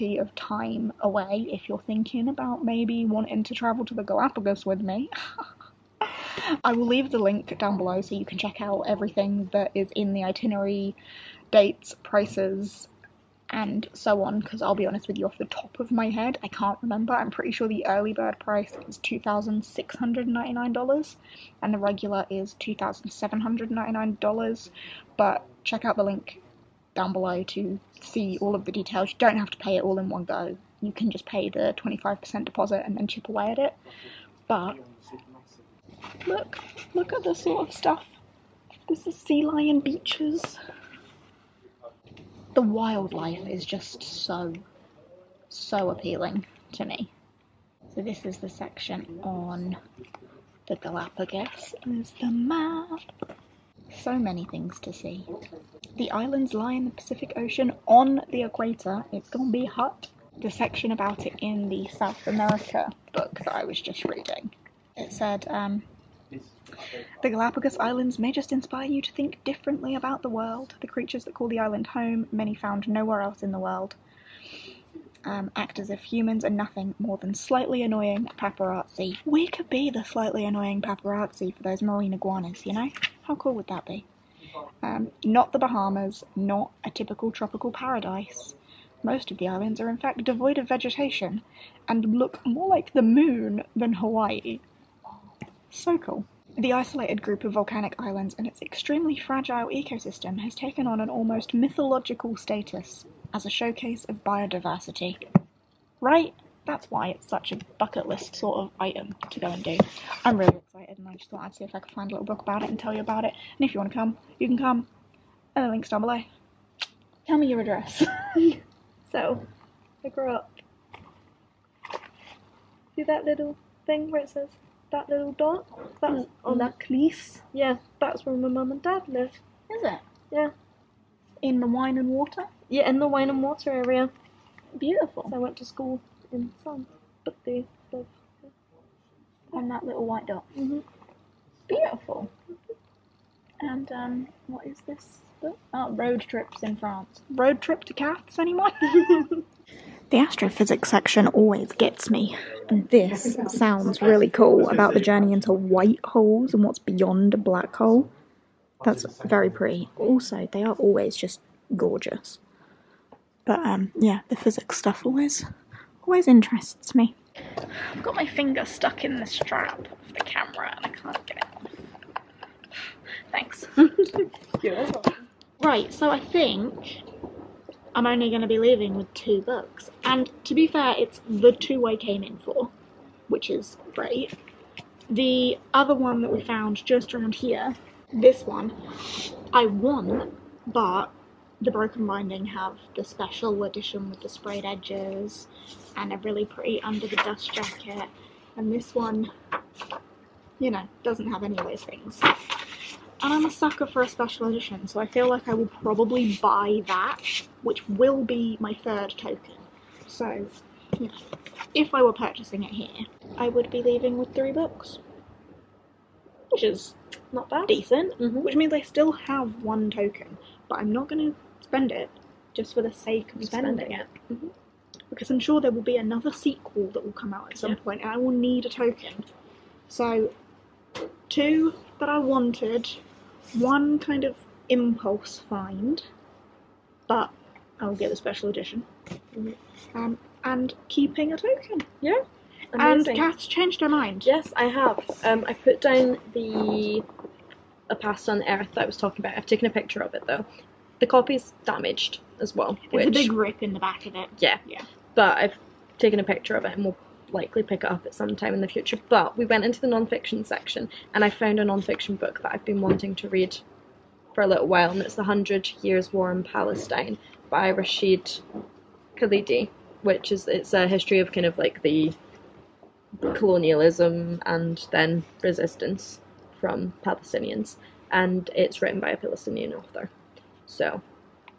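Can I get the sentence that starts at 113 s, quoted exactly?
And if you want to come, you can come.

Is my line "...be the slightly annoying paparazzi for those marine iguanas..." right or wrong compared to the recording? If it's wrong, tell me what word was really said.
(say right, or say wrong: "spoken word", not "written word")
right.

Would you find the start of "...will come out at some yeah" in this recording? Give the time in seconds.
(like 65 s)
227 s.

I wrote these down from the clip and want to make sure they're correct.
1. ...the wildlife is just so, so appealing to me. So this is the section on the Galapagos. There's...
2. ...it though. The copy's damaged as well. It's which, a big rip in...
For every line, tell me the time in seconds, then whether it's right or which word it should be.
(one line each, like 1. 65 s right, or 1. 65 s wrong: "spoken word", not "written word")
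1. 42 s right
2. 250 s right.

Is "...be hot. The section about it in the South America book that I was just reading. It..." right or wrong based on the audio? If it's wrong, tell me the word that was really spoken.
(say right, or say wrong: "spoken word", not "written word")
right.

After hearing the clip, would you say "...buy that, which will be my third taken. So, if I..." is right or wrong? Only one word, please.
wrong.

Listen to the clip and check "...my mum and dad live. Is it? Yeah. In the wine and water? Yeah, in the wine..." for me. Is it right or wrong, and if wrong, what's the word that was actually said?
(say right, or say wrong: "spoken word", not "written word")
right.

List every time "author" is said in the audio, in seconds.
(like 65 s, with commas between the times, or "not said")
279 s.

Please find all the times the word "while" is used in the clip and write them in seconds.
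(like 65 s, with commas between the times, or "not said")
264 s.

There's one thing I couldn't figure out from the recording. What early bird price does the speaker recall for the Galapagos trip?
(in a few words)
$2,699.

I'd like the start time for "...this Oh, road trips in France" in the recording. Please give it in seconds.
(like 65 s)
144 s.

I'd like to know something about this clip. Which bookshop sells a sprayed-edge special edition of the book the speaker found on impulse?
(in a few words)
The Broken Binding.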